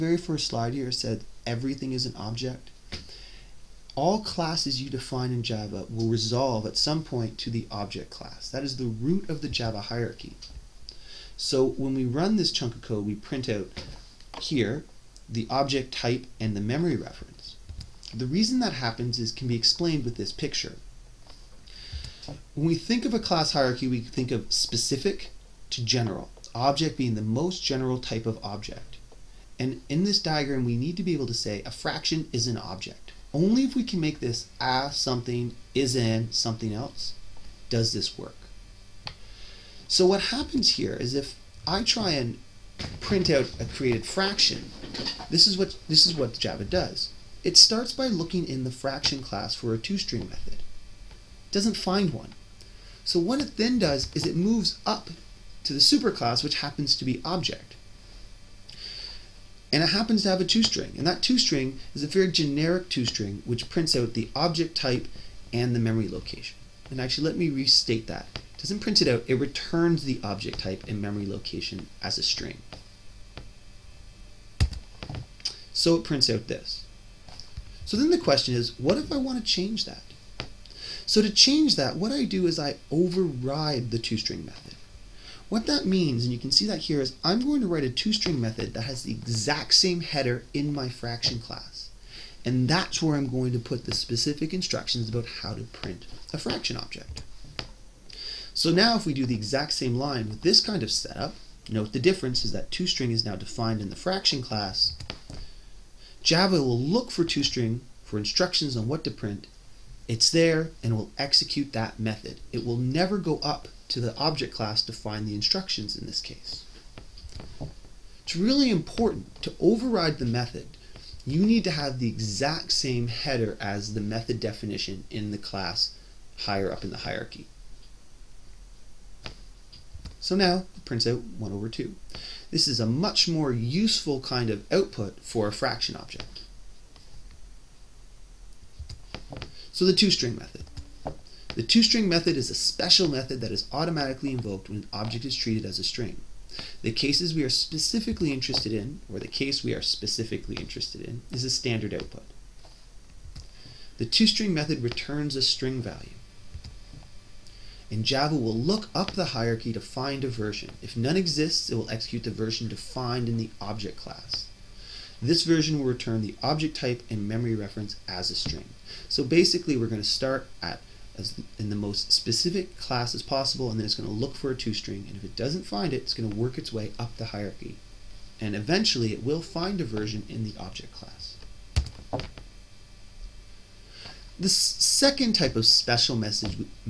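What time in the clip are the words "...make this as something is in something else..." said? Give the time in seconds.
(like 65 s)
33 s.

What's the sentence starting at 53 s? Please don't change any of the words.
So what it then does is it moves up to the superclass, which happens to be object.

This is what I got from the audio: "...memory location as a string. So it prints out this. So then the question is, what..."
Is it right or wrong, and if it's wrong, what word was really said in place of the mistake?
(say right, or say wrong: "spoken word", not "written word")
right.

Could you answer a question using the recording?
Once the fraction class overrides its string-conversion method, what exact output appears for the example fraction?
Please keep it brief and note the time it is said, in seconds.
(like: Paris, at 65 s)
1 over 2, at 131 s.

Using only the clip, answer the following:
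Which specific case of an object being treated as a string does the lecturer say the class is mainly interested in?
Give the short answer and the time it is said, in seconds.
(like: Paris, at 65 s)
standard output, at 151 s.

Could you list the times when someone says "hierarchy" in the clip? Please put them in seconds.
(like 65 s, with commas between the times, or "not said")
9 s, 23 s, 126 s, 159 s, 177 s.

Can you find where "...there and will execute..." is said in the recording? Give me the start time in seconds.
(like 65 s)
110 s.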